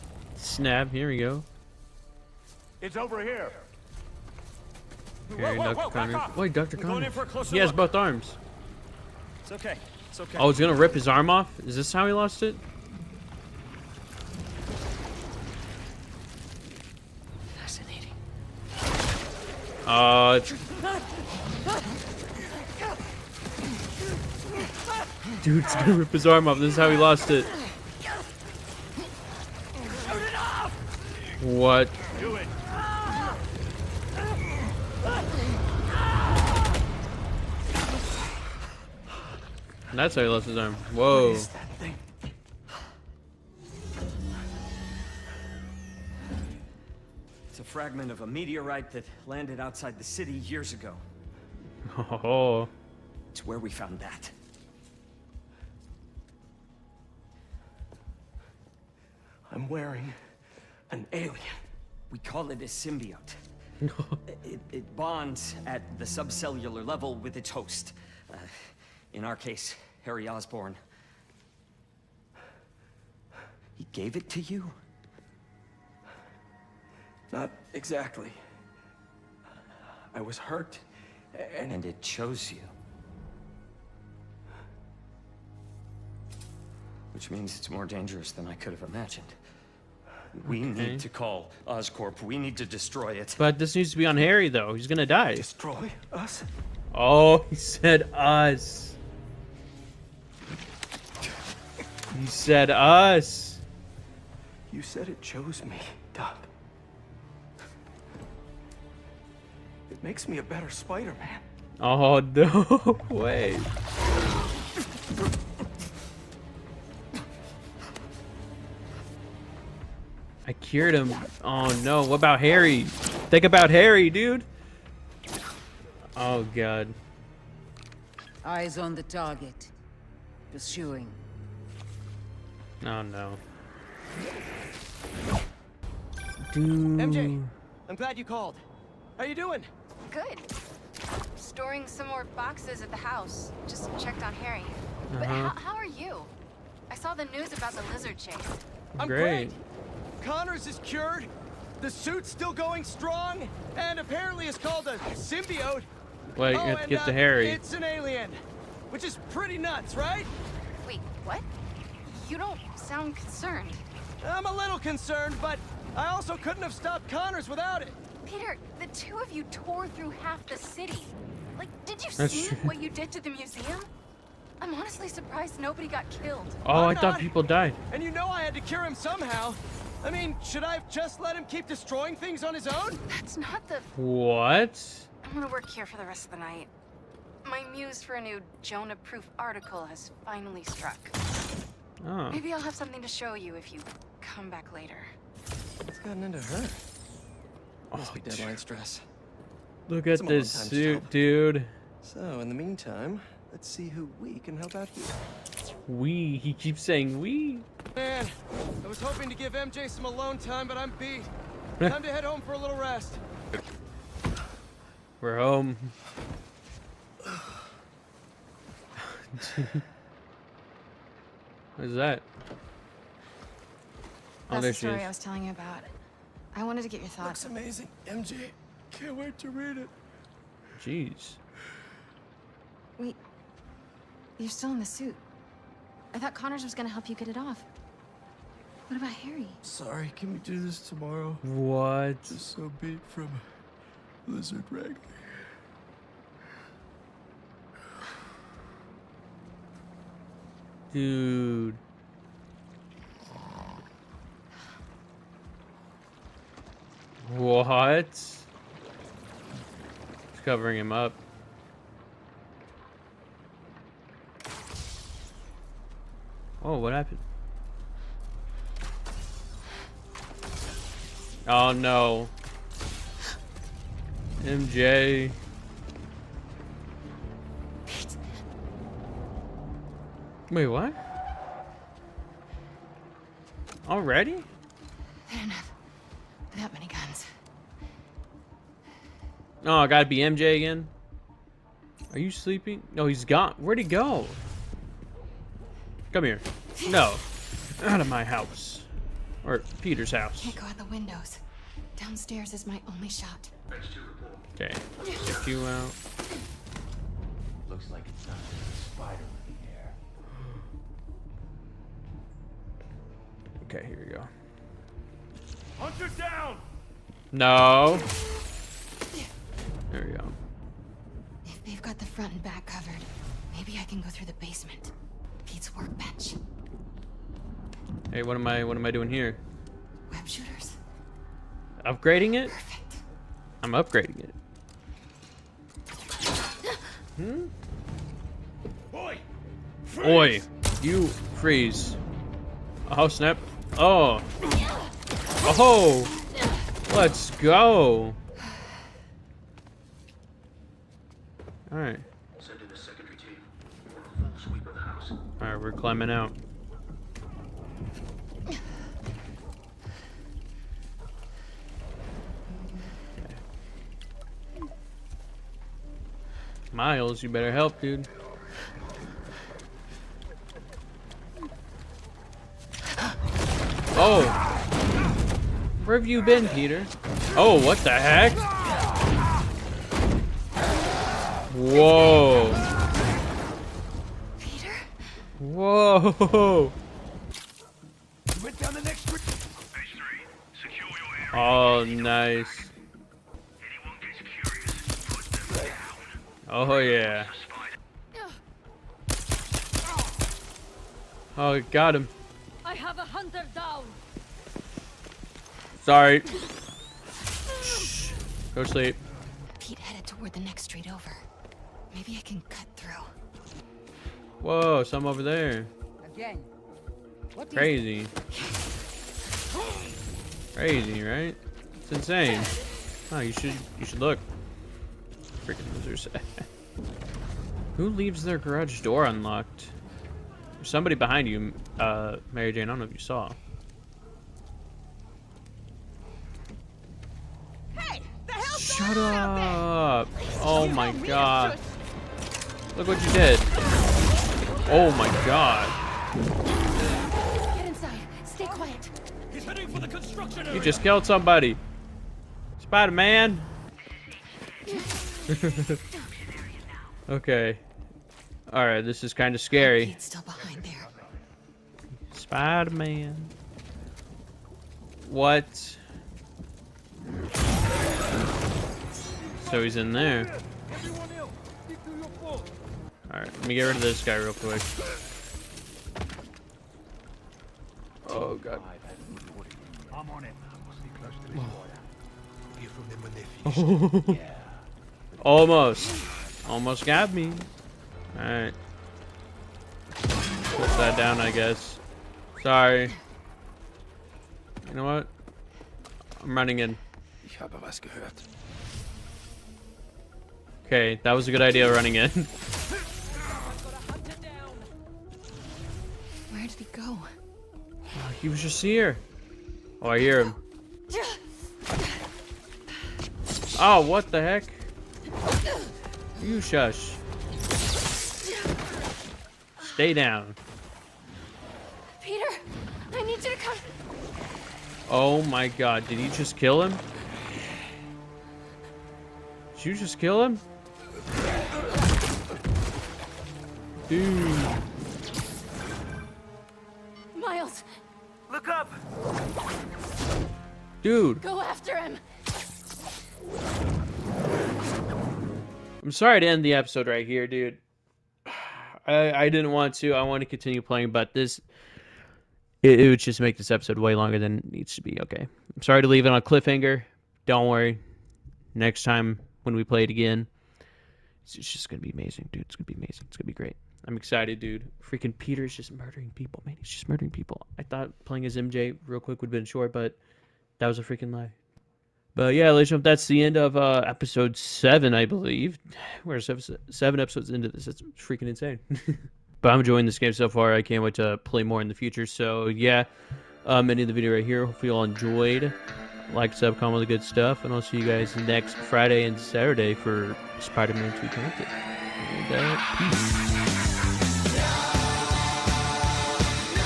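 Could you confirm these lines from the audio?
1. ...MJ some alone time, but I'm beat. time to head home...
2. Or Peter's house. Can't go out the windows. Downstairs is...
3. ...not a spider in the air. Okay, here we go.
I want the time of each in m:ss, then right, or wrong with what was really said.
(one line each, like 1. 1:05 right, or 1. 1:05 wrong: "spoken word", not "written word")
1. 3:29 right
2. 4:59 right
3. 5:08 right.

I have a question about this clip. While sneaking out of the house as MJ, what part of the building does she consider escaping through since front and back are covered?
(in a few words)
The basement.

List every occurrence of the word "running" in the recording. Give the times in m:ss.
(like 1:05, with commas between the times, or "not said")
8:16, 8:21.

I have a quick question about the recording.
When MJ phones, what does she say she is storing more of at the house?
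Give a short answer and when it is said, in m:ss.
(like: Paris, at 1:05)
Boxes, at 2:22.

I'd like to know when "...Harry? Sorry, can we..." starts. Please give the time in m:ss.
3:59.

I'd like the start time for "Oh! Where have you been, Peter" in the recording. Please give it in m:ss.
6:13.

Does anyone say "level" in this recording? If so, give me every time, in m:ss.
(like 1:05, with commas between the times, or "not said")
1:06.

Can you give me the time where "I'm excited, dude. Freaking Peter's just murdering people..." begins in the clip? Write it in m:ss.
9:23.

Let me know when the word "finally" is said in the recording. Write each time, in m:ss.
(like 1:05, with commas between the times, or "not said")
3:10.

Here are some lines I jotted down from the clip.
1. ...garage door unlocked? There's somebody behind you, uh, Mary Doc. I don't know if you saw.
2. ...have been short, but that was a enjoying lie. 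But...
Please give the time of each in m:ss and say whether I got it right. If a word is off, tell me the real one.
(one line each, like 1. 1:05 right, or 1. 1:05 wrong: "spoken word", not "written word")
1. 7:08 wrong: "Jane", not "Doc"
2. 9:29 wrong: "freaking", not "enjoying".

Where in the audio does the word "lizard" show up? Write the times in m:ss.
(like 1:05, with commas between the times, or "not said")
2:27, 4:04.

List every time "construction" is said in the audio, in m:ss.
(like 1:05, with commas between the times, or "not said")
7:29.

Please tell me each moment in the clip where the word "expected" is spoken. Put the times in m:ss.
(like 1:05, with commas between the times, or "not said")
not said.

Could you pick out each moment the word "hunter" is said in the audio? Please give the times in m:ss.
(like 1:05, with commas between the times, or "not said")
5:15, 6:43.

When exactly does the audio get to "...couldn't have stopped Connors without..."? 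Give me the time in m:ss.
2:46.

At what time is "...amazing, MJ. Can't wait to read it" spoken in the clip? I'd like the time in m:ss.
3:47.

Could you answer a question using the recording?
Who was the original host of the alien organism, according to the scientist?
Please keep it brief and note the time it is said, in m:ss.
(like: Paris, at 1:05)
Harry Osborn, at 1:10.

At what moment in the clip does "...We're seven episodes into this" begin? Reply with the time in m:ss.
9:36.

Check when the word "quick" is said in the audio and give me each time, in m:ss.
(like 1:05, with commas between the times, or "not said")
7:54, 9:28.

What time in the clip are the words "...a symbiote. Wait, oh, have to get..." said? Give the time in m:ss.
2:34.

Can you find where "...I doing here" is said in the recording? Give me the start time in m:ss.
5:28.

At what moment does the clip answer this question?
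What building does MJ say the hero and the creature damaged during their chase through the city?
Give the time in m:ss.
2:53.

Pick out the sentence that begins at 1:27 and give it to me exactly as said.
Which means it's more dangerous than I could have imagined.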